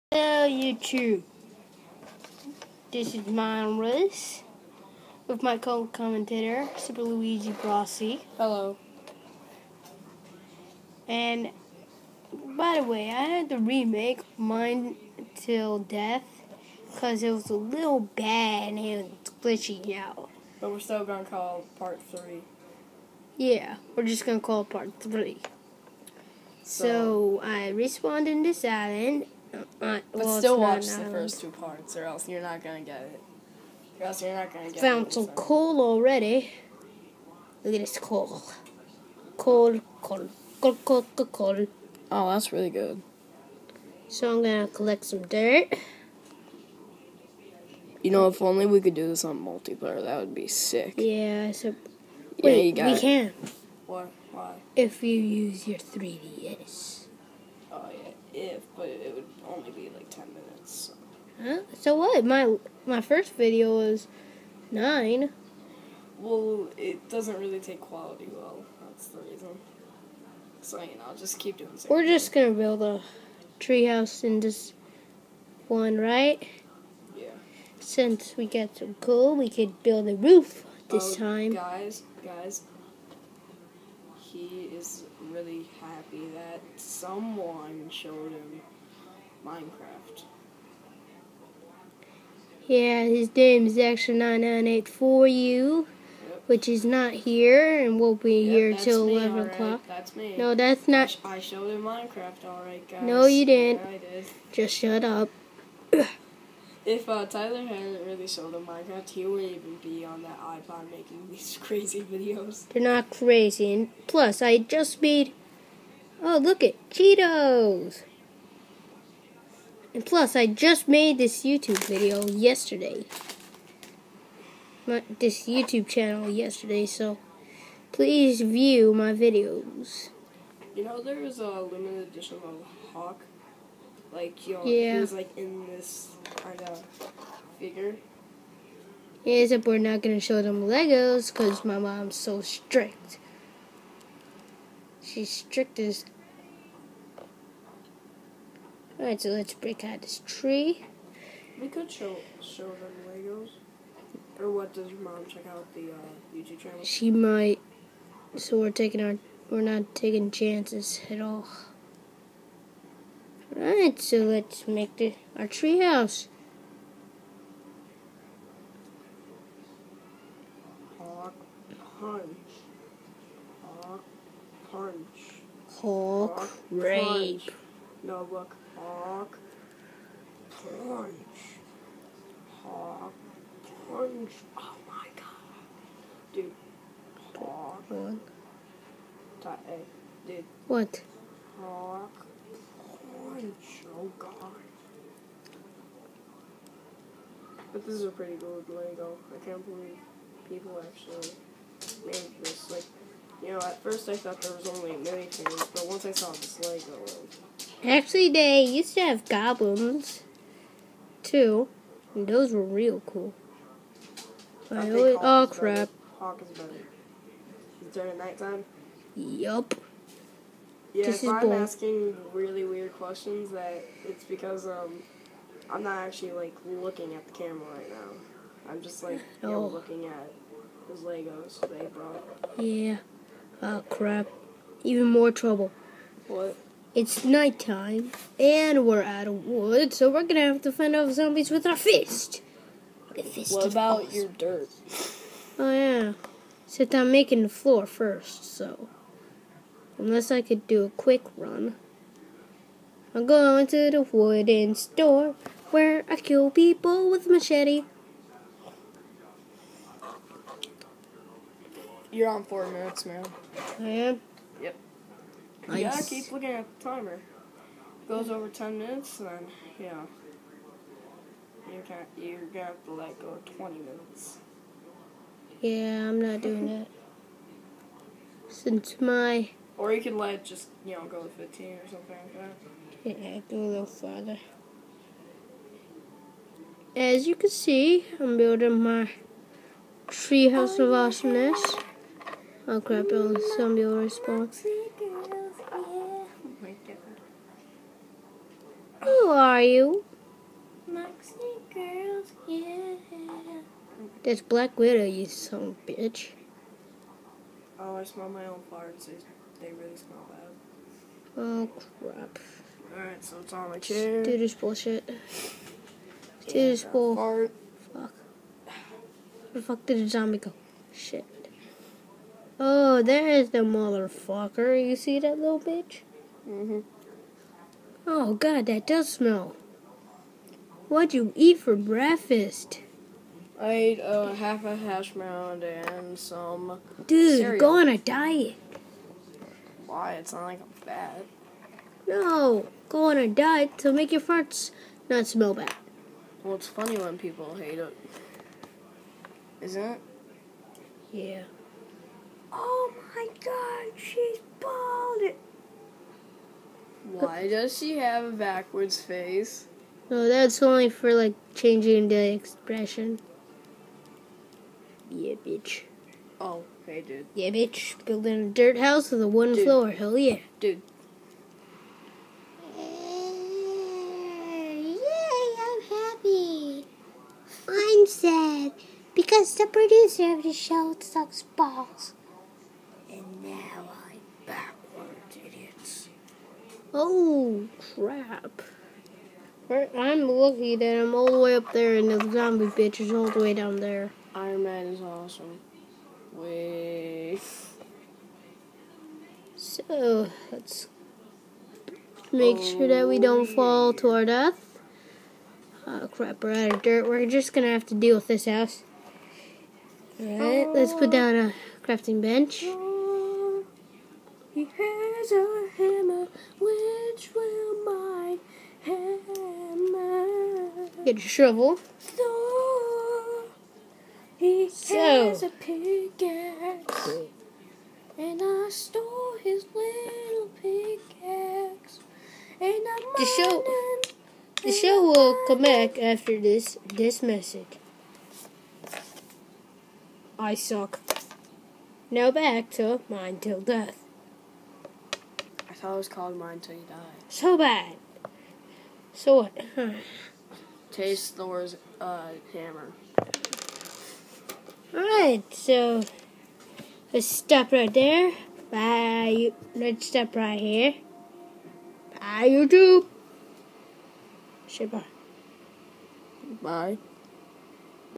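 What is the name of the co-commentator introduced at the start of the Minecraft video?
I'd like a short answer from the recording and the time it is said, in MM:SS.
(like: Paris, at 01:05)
Super Luigi Grossi, at 00:06.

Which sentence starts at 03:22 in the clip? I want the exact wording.
Like, you know, at first I thought there was only things, but once I saw this Lego.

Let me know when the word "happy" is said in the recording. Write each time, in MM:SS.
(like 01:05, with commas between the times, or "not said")
01:25, 06:15.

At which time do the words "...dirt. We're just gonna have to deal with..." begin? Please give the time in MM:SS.
06:46.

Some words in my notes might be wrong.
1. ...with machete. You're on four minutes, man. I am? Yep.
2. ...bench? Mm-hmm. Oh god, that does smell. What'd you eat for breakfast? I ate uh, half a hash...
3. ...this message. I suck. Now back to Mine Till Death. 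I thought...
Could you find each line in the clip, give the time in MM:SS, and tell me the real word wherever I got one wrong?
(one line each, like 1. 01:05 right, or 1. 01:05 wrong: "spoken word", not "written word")
1. 04:17 right
2. 05:25 wrong: "bitch", not "bench"
3. 07:16 right.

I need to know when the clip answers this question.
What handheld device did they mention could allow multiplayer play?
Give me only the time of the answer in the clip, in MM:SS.
00:55.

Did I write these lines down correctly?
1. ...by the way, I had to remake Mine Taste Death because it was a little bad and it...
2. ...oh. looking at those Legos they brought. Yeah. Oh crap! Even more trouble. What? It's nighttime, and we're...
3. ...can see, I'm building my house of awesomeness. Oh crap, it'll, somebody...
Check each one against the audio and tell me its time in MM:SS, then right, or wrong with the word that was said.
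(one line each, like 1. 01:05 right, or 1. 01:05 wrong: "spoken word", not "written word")
1. 00:12 wrong: "Till", not "Taste"
2. 03:49 right
3. 04:47 wrong: "treehouse", not "house".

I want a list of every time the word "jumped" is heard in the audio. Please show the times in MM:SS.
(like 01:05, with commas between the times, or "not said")
not said.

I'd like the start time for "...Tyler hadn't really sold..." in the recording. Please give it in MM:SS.
01:47.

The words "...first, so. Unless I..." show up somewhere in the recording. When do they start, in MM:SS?
04:07.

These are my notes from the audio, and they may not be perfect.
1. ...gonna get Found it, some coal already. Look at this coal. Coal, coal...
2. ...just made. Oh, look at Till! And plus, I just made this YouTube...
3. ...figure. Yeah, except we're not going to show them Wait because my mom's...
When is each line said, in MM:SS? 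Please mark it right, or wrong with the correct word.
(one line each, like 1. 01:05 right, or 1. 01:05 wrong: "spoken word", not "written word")
1. 00:34 right
2. 01:54 wrong: "Cheetos", not "Till"
3. 02:17 wrong: "Legos", not "Wait".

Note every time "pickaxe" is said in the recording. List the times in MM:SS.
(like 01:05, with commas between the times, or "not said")
07:05, 07:10.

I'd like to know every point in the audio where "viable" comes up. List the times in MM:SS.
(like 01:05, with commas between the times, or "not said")
not said.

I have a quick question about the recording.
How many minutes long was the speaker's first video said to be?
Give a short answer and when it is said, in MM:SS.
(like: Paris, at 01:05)
9, at 01:04.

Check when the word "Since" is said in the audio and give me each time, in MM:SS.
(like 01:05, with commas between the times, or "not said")
01:17, 04:38.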